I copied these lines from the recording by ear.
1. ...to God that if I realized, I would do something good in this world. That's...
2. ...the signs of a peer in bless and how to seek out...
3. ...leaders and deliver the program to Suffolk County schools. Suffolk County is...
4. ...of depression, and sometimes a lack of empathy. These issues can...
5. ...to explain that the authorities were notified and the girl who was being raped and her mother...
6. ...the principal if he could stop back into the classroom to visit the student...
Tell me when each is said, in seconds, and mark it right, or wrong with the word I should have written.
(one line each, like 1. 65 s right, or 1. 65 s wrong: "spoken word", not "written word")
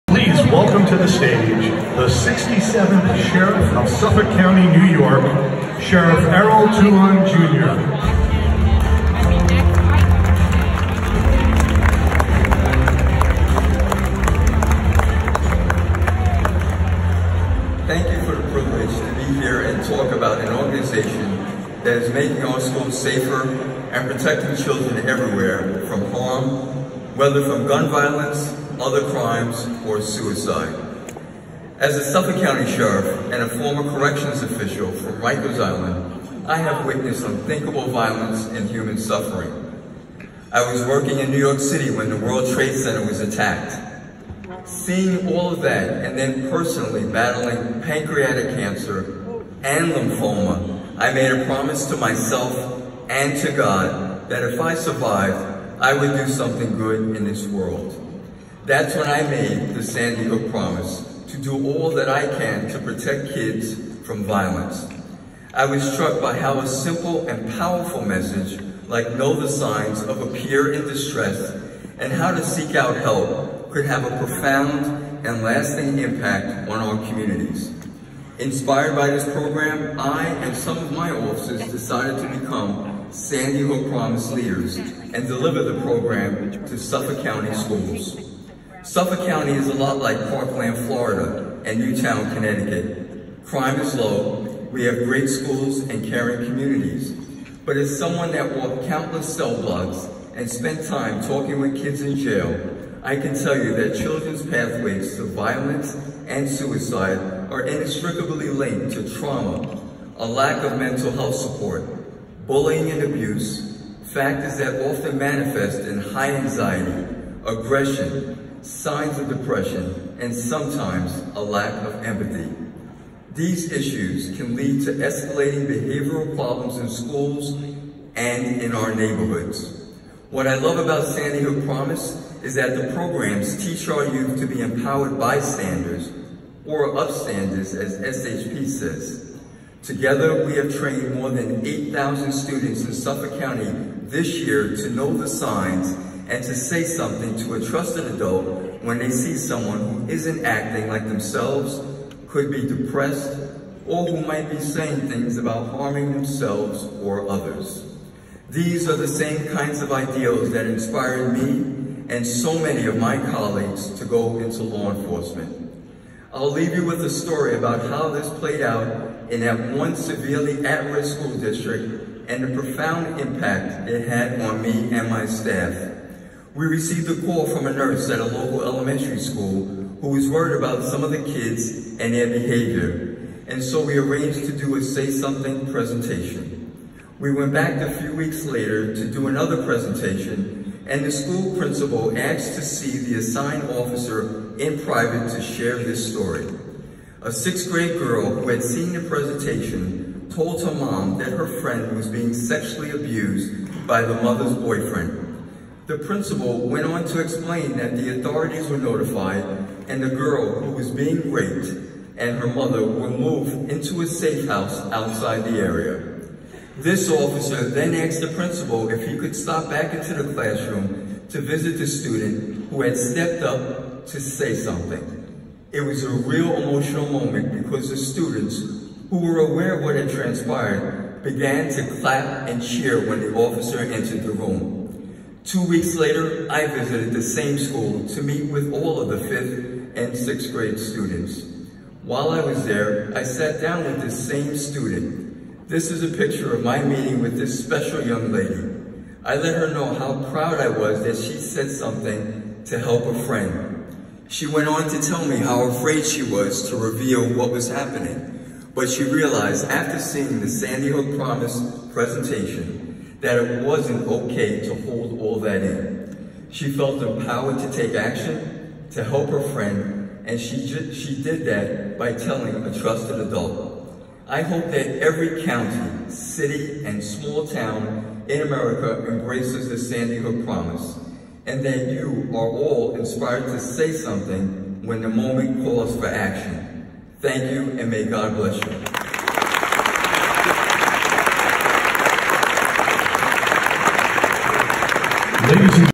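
1. 53 s wrong: "survived", not "realized"
2. 69 s wrong: "distress", not "bless"
3. 84 s right
4. 119 s right
5. 207 s right
6. 218 s right.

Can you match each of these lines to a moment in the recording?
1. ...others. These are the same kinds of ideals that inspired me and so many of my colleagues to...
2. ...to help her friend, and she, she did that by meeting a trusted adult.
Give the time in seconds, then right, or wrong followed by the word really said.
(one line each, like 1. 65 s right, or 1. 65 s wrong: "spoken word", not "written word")
1. 157 s right
2. 268 s wrong: "telling", not "meeting".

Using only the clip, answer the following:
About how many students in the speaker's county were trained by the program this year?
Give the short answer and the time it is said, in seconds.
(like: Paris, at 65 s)
8,000, at 141 s.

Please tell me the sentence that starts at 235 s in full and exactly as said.
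Two weeks later, I visited the same school to meet with all of the fifth and sixth grade students.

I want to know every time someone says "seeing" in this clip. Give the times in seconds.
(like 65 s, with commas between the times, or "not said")
44 s, 259 s.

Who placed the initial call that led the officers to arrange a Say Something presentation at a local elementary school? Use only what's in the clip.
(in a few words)
a nurse.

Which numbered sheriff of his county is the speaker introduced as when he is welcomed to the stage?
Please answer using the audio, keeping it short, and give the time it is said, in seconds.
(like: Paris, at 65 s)
67th, at 2 s.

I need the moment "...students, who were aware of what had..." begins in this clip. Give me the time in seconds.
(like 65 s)
227 s.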